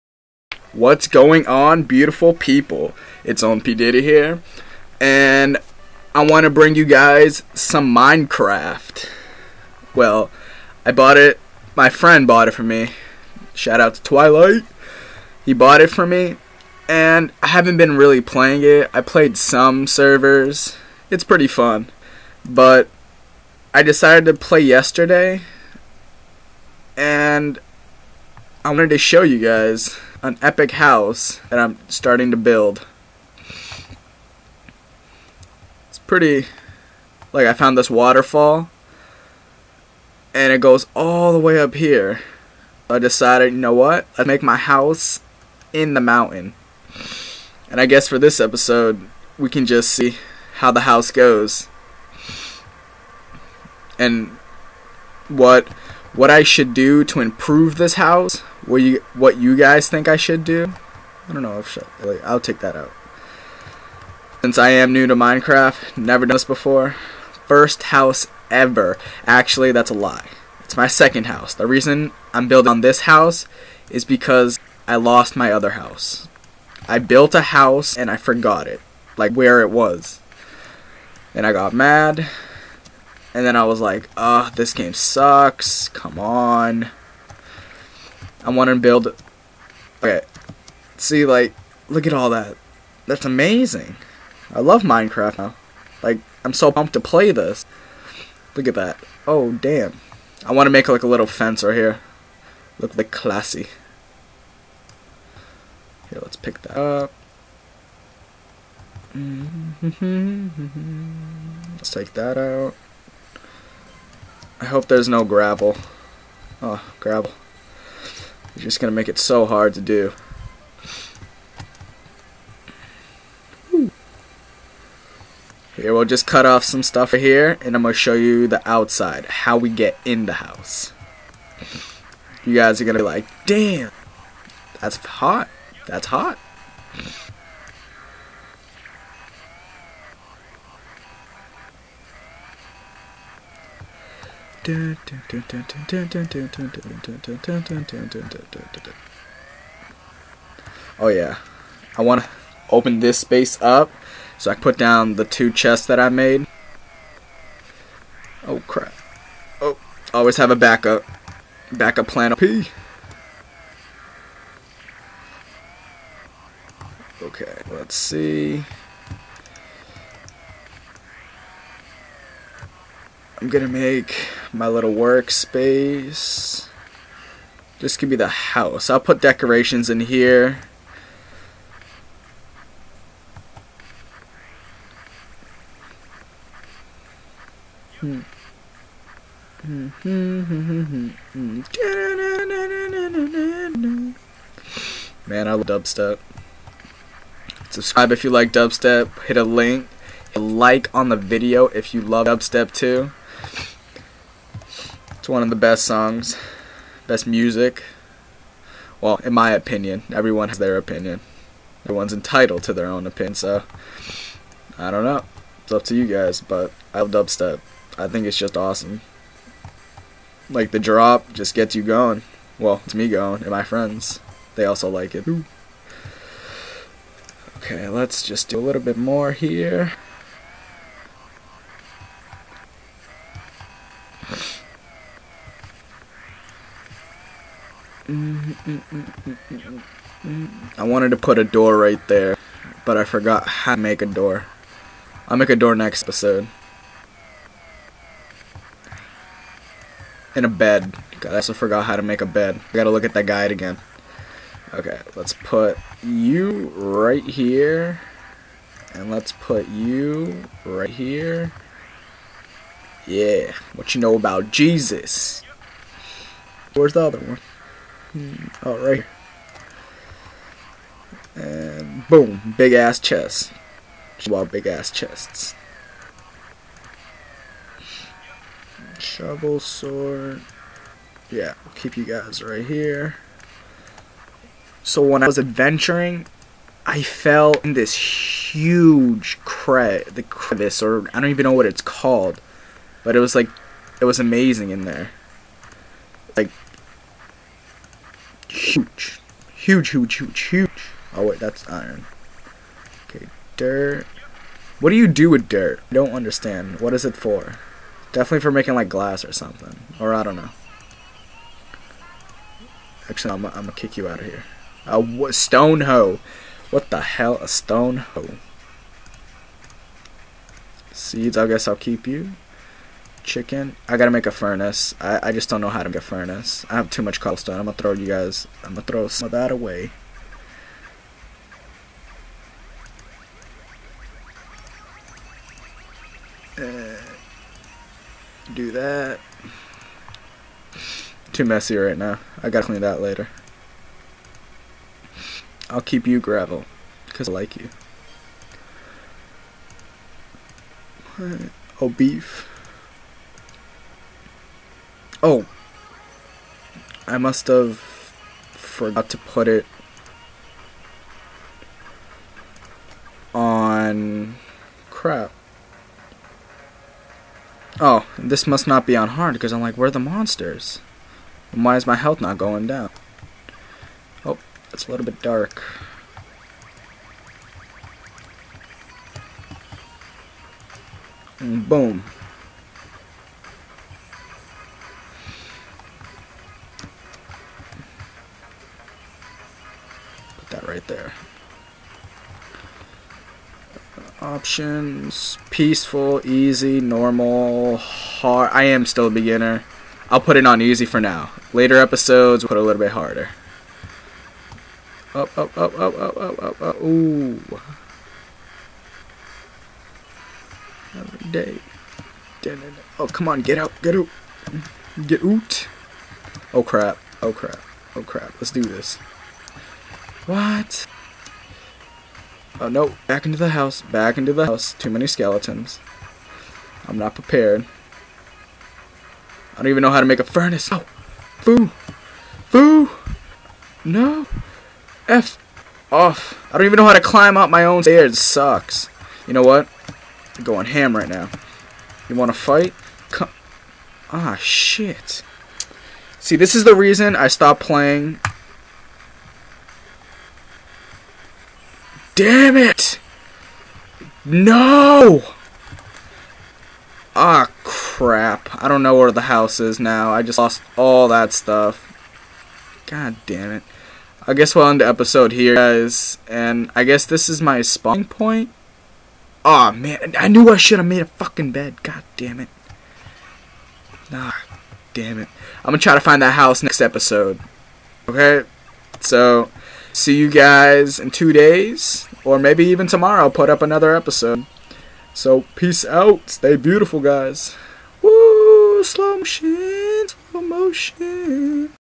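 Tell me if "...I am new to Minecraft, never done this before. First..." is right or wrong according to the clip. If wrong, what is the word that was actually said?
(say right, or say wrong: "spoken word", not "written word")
right.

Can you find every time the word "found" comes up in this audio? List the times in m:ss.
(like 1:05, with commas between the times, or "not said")
0:37.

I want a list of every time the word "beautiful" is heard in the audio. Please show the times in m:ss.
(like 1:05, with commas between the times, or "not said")
0:01, 8:06.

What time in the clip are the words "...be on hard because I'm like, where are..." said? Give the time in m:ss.
6:08.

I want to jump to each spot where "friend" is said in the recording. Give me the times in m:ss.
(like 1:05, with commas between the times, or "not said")
0:11, 3:43.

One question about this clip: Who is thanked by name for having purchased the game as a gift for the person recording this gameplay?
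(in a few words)
Twilight.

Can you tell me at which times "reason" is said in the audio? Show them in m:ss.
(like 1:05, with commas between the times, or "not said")
1:11, 7:26.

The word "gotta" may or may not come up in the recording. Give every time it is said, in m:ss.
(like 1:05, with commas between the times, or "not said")
4:12, 5:23, 5:42.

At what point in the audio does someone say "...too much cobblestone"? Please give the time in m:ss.
5:26.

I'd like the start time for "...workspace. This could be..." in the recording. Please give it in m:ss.
2:54.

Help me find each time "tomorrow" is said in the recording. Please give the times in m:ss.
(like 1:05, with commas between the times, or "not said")
8:02.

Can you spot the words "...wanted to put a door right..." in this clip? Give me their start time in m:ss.
4:00.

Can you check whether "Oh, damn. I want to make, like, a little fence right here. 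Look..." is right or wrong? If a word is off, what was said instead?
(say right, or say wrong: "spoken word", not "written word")
right.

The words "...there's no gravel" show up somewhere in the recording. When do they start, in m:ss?
1:54.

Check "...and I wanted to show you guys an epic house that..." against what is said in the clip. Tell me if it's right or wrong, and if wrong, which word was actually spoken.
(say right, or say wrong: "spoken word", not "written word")
right.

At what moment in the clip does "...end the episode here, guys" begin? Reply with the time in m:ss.
7:44.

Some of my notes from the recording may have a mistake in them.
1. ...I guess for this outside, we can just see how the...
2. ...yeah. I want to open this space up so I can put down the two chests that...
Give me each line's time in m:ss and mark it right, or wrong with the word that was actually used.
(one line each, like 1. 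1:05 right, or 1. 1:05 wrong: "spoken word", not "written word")
1. 0:47 wrong: "episode", not "outside"
2. 2:31 right.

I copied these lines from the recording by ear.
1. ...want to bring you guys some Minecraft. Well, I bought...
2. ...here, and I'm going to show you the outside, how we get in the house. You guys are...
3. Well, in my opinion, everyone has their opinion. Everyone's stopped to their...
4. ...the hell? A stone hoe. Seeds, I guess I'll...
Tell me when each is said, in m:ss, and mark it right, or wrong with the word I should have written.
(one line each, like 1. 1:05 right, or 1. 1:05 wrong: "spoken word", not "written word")
1. 0:06 right
2. 2:07 right
3. 3:28 wrong: "entitled", not "stopped"
4. 5:16 right.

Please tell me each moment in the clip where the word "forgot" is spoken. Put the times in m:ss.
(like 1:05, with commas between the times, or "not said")
1:18, 4:03, 4:11, 5:57.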